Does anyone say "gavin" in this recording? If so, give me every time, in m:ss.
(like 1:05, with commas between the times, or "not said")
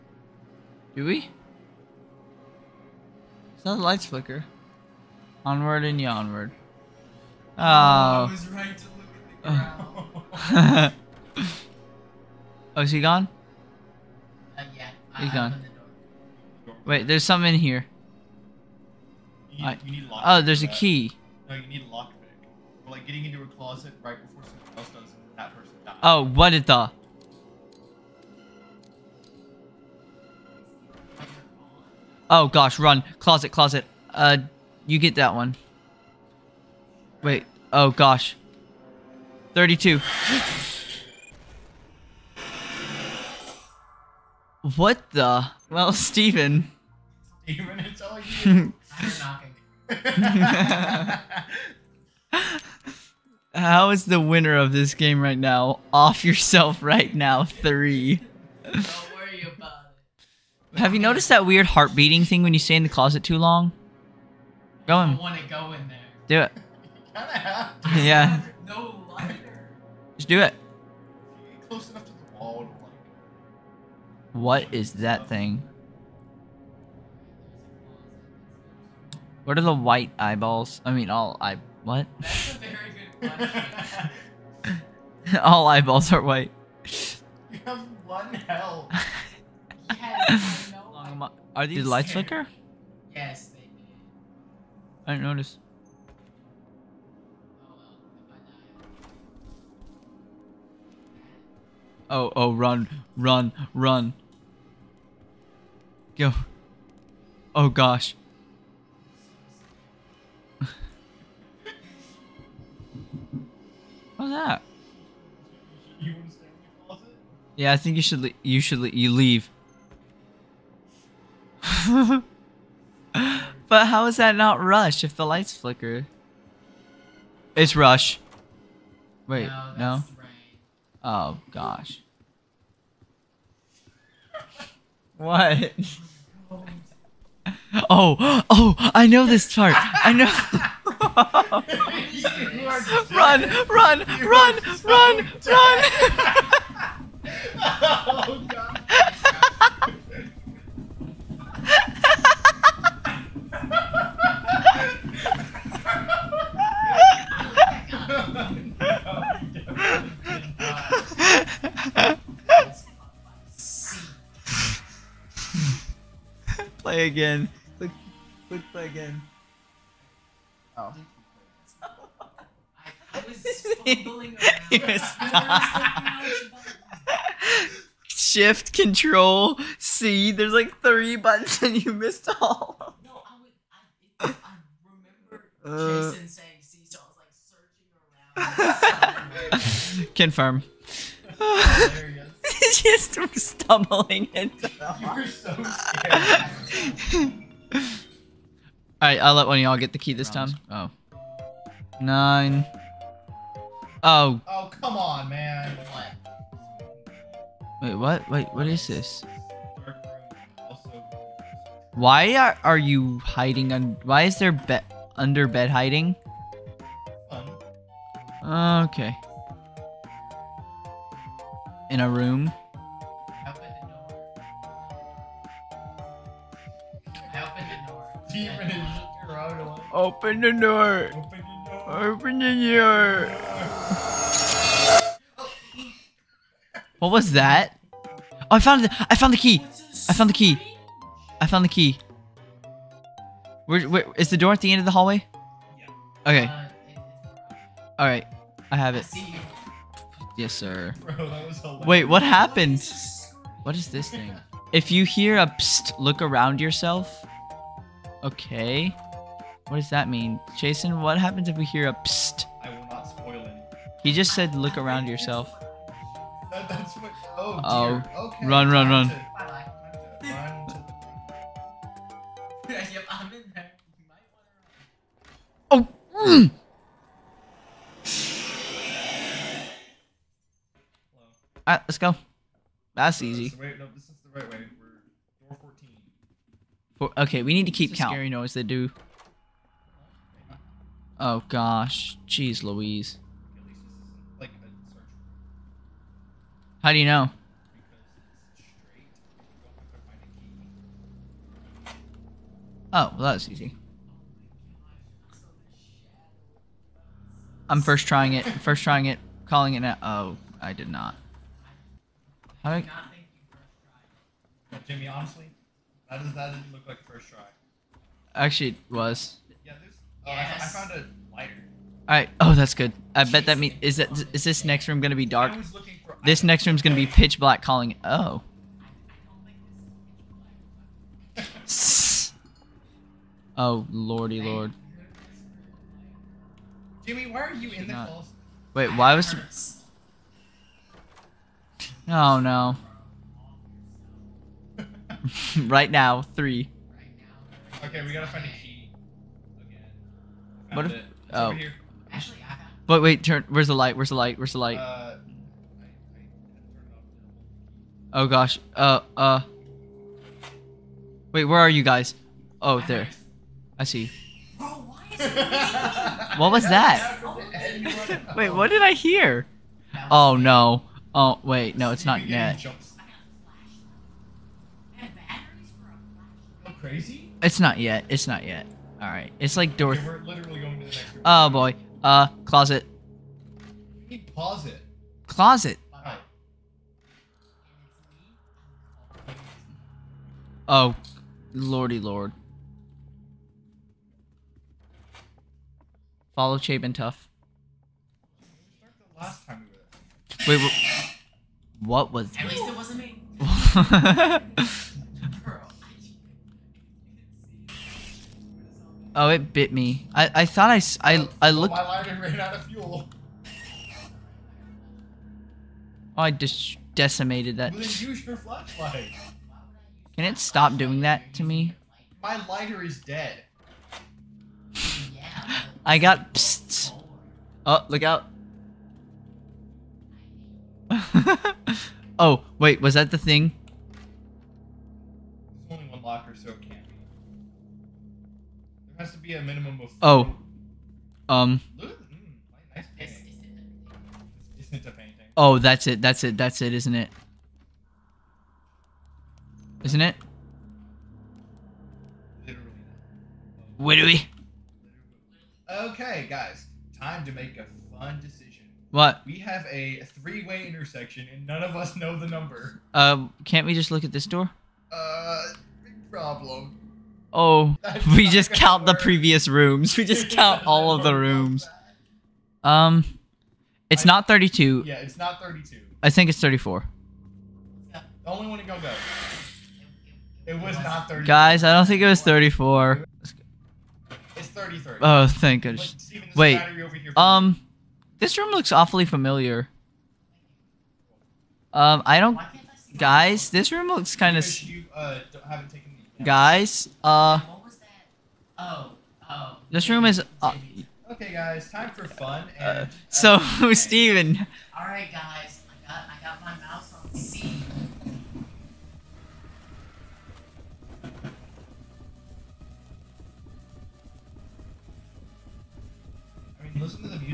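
not said.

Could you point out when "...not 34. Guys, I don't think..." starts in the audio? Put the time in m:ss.
8:00.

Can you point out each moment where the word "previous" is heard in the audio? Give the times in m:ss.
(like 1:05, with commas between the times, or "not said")
7:49.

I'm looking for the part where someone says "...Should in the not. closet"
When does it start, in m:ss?
5:37.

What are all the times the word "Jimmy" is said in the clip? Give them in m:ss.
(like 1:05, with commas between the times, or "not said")
5:14, 5:37.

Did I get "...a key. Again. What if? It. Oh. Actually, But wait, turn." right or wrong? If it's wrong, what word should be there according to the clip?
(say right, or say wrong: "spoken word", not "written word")
right.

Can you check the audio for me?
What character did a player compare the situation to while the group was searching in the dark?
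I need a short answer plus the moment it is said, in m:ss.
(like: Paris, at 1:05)
Dorothy, at 6:19.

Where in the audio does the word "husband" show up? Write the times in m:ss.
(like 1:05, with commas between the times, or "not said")
not said.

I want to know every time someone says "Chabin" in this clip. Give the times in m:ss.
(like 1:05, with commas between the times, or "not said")
6:36.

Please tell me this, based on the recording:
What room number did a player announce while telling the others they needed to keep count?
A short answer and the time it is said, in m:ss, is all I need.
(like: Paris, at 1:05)
14, at 4:45.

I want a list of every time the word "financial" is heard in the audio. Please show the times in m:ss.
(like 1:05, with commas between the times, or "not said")
not said.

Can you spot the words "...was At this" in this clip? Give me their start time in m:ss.
6:42.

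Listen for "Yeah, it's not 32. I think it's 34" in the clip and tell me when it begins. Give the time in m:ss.
7:54.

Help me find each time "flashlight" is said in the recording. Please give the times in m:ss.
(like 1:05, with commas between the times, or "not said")
6:58.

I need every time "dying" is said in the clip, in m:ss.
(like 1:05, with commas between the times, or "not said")
not said.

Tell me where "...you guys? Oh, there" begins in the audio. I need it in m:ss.
6:01.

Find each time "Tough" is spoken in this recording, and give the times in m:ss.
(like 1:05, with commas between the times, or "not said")
6:36.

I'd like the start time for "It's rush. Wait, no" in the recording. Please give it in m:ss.
2:07.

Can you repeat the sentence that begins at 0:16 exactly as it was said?
The Wait, there's something in here.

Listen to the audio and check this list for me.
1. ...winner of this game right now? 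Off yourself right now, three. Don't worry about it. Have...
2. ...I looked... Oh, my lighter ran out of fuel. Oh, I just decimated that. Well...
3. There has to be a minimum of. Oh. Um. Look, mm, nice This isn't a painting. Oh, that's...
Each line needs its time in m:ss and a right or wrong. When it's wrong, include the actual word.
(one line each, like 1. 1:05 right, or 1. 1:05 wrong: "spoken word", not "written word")
1. 0:54 right
2. 6:51 right
3. 7:18 right.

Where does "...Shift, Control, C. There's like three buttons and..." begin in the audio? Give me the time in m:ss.
2:58.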